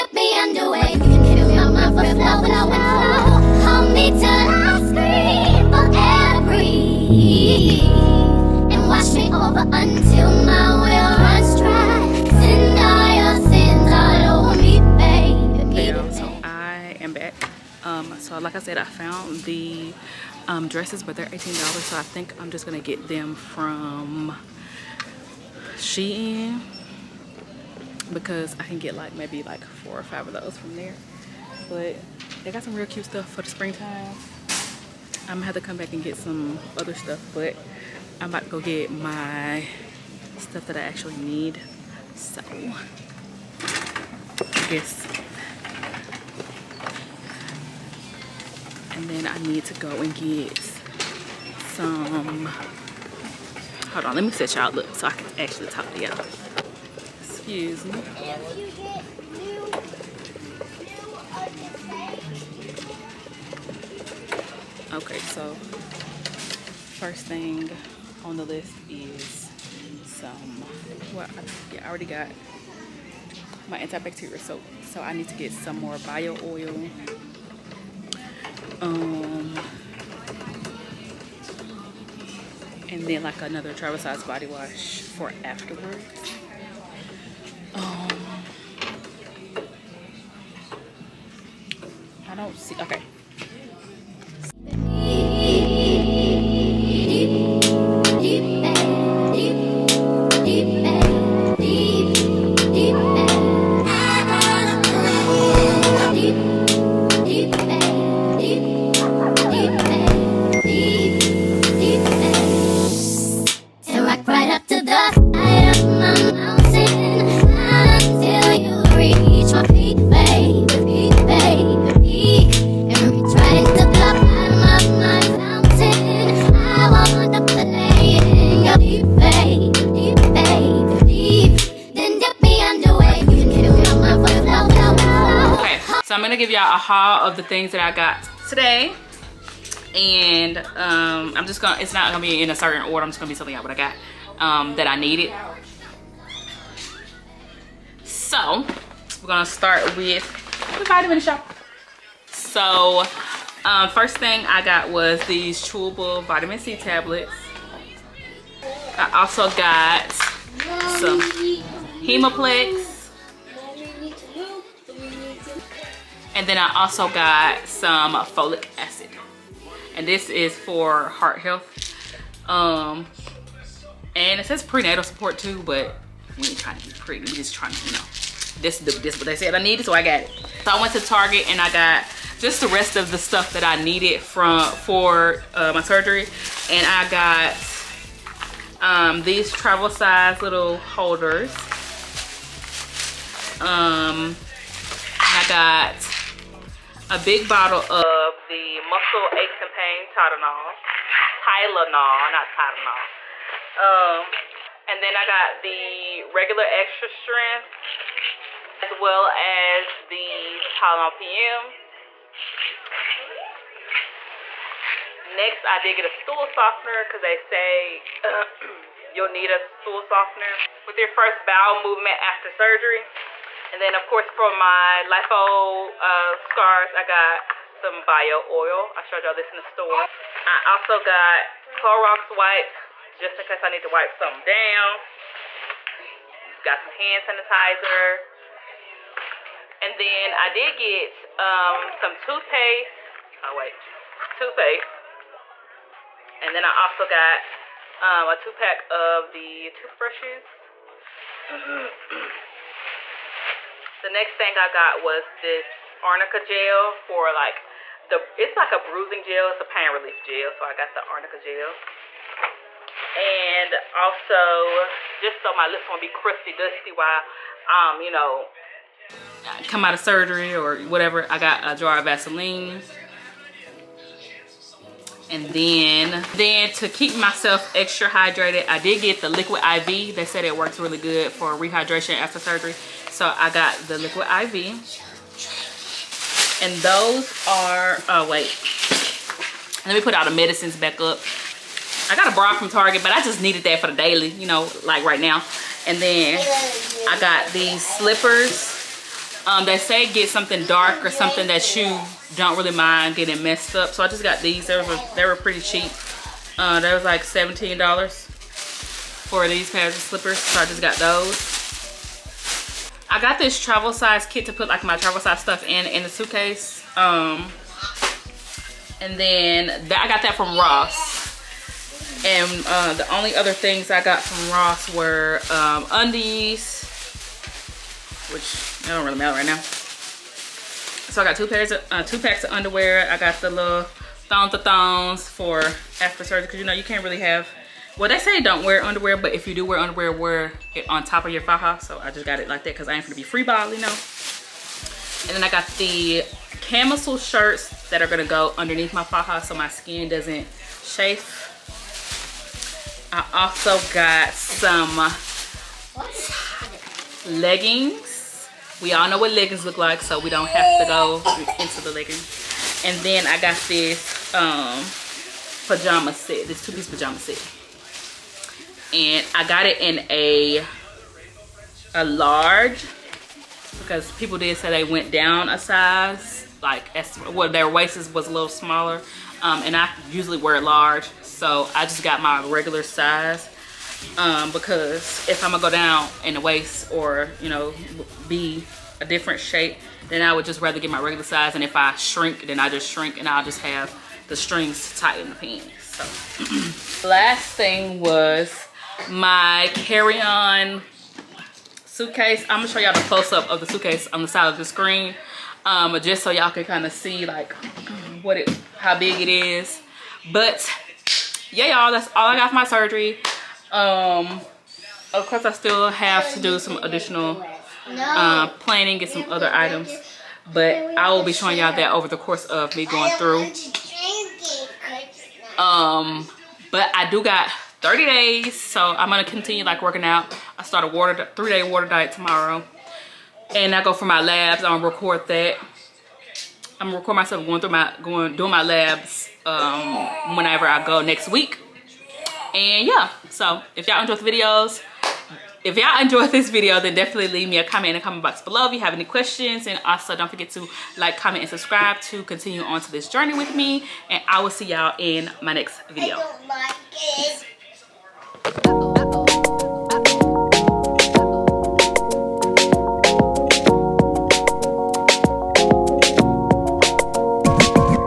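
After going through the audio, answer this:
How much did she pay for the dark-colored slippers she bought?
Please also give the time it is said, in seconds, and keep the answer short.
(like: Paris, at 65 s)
$17, at 307 s.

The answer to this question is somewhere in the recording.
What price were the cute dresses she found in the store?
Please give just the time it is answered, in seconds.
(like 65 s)
21 s.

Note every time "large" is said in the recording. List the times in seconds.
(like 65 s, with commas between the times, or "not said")
372 s, 380 s.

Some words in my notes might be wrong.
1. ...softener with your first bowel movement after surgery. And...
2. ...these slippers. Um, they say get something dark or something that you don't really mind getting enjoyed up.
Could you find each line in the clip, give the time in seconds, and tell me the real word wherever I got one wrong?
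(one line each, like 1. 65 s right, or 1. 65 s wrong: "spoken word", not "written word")
1. 220 s right
2. 297 s wrong: "messed", not "enjoyed".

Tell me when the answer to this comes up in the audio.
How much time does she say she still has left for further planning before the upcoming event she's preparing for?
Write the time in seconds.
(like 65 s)
427 s.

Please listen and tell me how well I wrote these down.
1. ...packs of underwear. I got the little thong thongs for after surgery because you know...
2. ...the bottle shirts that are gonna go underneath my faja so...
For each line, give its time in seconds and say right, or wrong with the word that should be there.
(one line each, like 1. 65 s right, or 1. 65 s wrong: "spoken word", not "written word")
1. 332 s right
2. 345 s wrong: "camisole", not "bottle".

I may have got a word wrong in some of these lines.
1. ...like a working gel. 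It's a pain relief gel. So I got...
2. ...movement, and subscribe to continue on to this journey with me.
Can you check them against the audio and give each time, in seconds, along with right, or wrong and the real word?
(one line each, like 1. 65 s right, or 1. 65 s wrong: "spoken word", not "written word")
1. 258 s wrong: "bruising", not "working"
2. 451 s wrong: "comment", not "movement".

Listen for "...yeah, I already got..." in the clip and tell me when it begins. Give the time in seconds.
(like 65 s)
71 s.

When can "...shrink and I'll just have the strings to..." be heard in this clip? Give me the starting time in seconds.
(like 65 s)
392 s.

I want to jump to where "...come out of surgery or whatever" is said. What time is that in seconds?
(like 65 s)
269 s.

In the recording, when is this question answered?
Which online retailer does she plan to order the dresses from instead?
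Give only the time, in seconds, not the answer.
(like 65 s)
25 s.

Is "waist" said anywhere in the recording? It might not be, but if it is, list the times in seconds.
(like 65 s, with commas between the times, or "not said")
377 s, 386 s.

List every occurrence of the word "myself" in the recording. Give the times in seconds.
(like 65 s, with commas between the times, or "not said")
277 s, 437 s.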